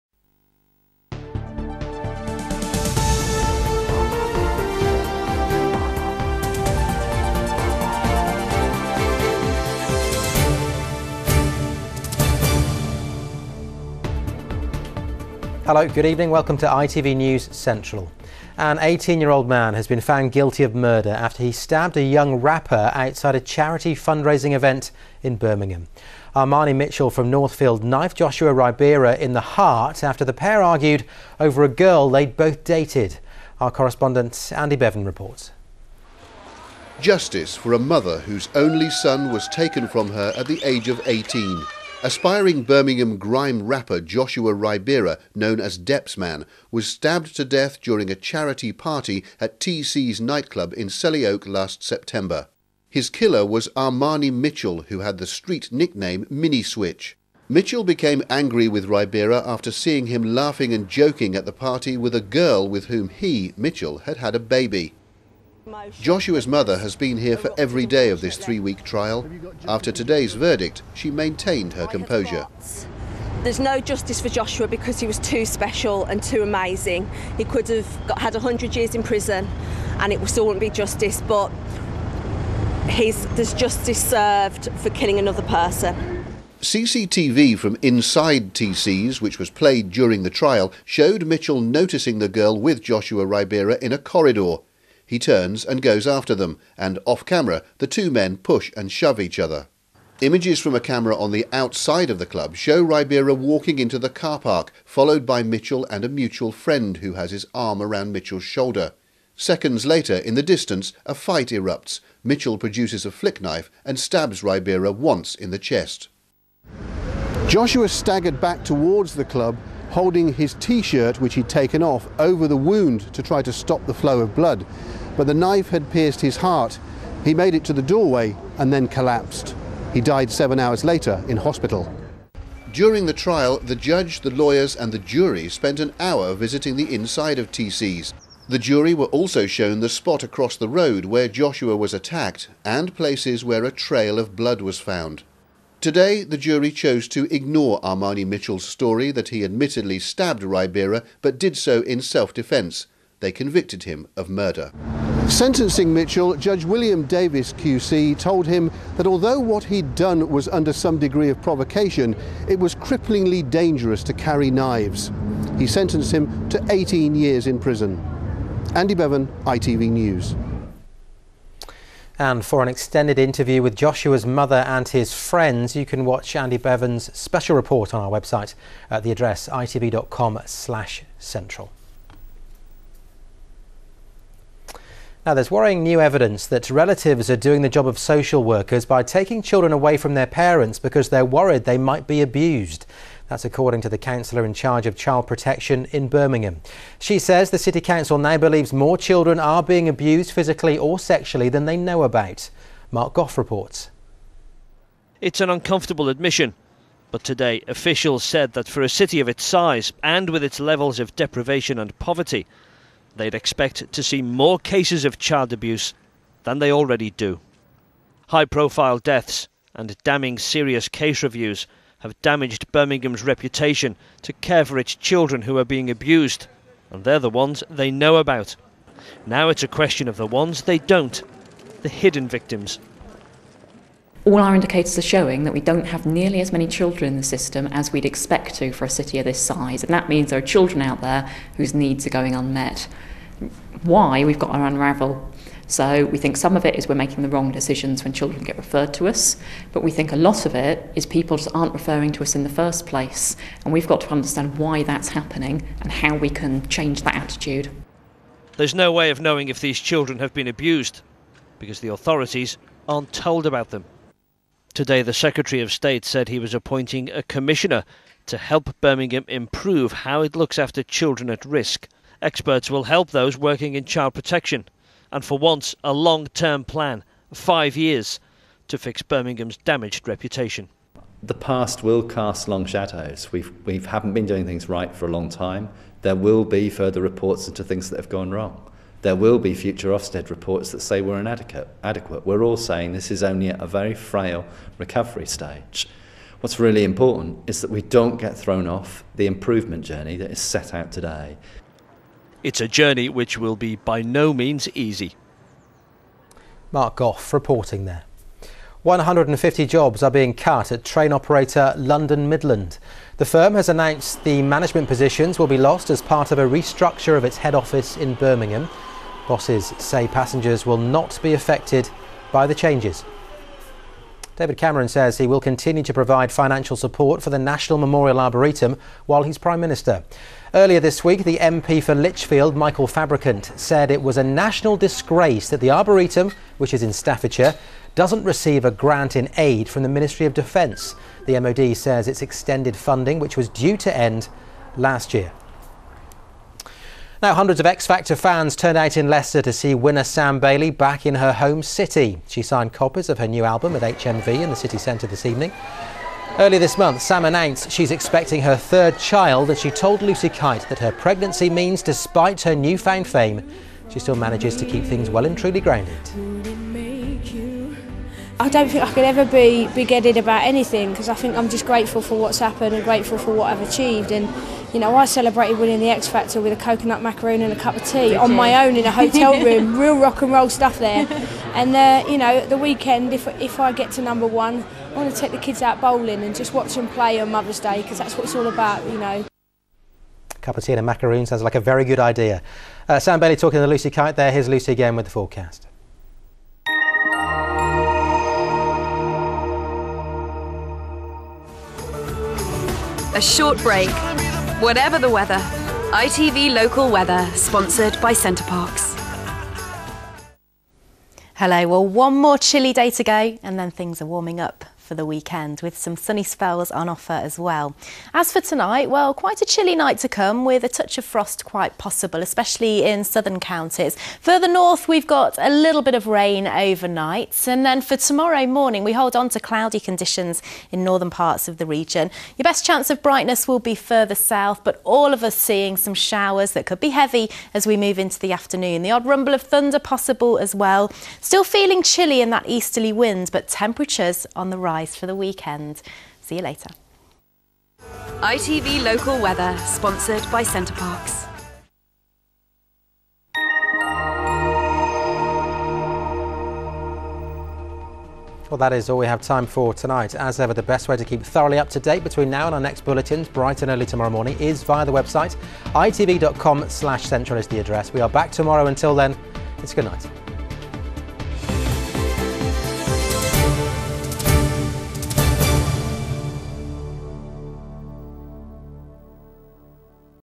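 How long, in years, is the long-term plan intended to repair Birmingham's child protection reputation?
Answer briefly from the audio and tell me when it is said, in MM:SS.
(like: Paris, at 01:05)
5, at 04:37.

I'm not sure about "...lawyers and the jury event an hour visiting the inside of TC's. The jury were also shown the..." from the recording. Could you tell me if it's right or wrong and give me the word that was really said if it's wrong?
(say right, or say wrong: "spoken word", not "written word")
wrong: "spent", not "event".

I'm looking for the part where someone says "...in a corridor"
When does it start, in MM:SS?
01:33.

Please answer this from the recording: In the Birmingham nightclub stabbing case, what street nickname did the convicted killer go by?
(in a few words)
Mini Switch.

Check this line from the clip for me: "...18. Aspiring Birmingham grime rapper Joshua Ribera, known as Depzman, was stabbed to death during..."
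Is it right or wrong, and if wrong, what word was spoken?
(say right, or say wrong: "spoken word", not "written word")
right.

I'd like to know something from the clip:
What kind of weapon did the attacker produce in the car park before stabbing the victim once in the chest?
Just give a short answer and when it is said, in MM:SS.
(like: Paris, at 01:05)
Flick knife, at 01:53.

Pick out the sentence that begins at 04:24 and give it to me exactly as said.
Today, the Secretary of State said he was appointing a commissioner to help Birmingham improve how it looks after children at risk.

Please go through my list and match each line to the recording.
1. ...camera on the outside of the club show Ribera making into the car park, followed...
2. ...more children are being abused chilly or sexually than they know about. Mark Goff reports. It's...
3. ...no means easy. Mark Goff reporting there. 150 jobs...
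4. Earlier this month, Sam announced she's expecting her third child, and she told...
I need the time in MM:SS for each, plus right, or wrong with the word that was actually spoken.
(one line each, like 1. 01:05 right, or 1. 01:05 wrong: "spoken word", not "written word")
1. 01:40 wrong: "walking", not "making"
2. 03:18 wrong: "physically", not "chilly"
3. 05:04 right
4. 05:56 right.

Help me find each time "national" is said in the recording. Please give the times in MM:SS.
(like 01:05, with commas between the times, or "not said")
05:27, 05:34.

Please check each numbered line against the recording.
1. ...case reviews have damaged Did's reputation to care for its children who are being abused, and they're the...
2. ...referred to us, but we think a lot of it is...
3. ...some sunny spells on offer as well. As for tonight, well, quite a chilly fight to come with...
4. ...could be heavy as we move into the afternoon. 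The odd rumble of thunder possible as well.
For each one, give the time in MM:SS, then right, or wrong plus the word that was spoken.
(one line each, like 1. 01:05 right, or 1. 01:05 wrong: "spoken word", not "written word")
1. 03:40 wrong: "Birmingham", not "Did"
2. 04:08 right
3. 06:55 wrong: "night", not "fight"
4. 07:16 right.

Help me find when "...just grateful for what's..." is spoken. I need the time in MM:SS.
06:11.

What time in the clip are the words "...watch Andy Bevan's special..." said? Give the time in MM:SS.
02:56.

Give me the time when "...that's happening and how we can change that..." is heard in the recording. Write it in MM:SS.
04:14.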